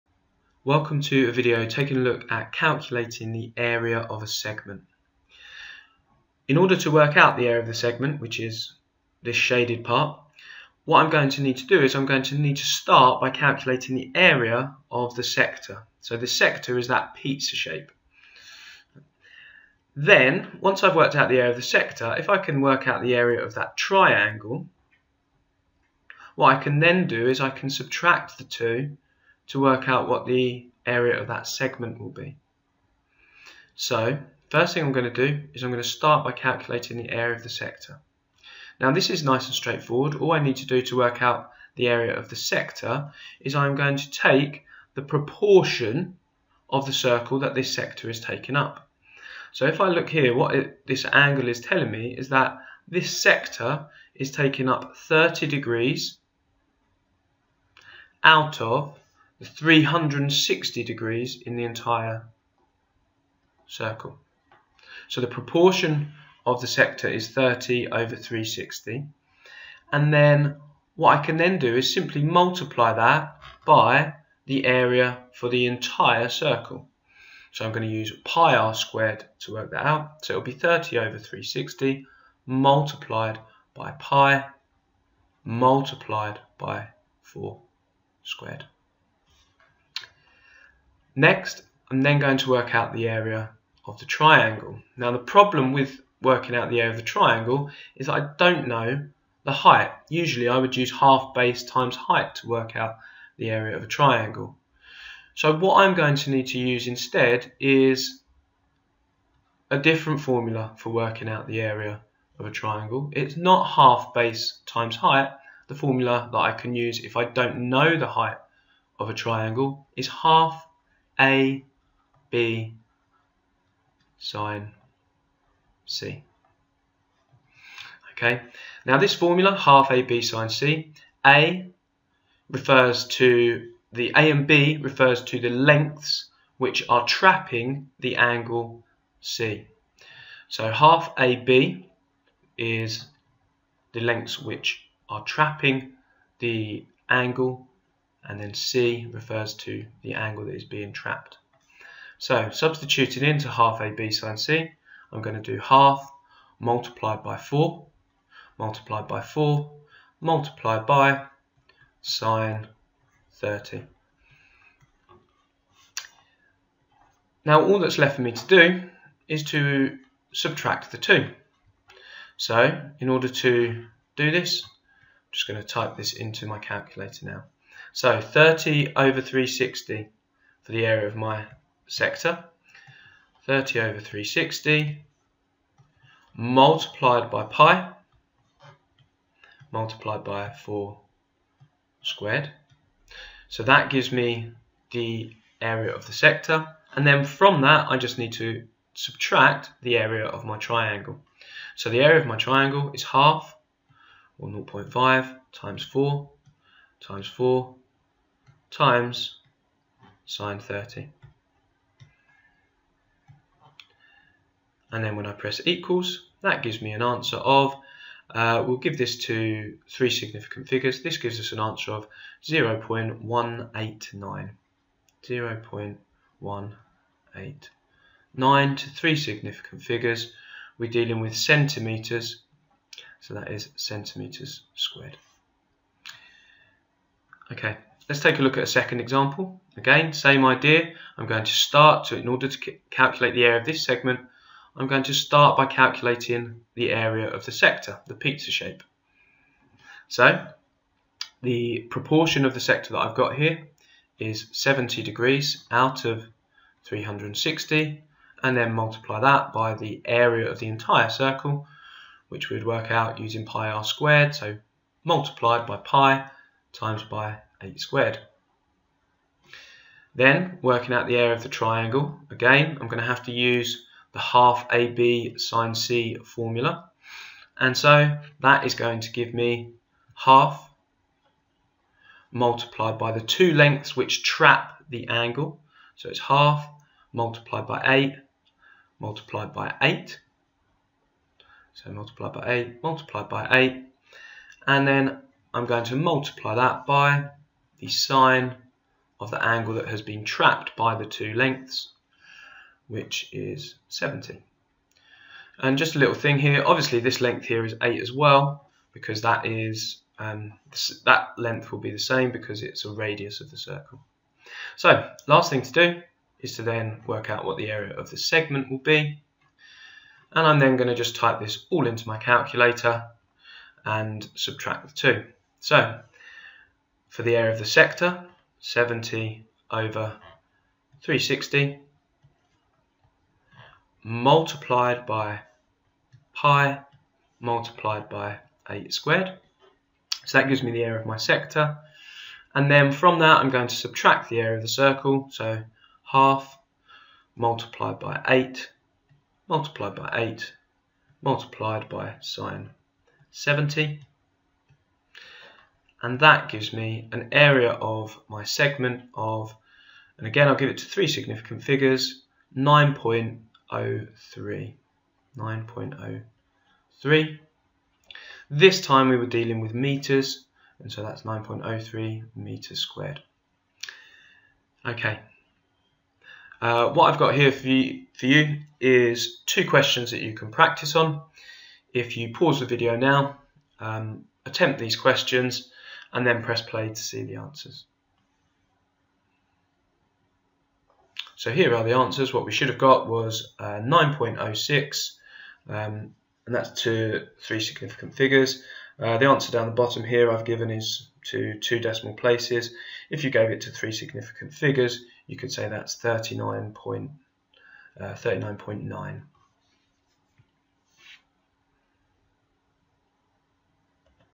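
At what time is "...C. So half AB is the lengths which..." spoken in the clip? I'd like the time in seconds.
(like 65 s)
139 s.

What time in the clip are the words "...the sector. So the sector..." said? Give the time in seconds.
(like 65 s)
15 s.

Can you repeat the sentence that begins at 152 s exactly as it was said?
So substituting into half AB sine C, I'm going to do half multiplied by 4, multiplied by 4, multiplied by sine 30.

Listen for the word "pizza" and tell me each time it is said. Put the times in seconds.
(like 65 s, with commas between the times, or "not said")
17 s, 248 s.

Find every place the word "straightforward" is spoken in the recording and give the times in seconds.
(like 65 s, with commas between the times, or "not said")
39 s.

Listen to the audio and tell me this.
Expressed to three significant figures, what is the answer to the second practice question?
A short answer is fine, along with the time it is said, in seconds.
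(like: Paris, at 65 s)
39.9, at 405 s.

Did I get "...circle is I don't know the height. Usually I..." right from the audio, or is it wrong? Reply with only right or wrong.
wrong.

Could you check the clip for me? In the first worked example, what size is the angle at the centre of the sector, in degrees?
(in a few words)
30.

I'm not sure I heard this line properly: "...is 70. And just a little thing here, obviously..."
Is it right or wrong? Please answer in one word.
right.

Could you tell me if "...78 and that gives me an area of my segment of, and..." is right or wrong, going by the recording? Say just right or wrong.
wrong.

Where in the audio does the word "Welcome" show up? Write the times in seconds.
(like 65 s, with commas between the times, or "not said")
0 s.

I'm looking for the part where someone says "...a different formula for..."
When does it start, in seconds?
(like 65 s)
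109 s.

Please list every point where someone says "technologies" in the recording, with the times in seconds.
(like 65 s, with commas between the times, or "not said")
not said.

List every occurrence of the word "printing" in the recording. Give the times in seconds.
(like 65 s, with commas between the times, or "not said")
not said.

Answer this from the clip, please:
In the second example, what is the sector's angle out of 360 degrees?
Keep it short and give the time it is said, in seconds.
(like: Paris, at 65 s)
70, at 254 s.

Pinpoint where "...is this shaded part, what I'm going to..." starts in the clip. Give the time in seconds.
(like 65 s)
8 s.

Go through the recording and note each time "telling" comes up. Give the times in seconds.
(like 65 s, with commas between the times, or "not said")
51 s.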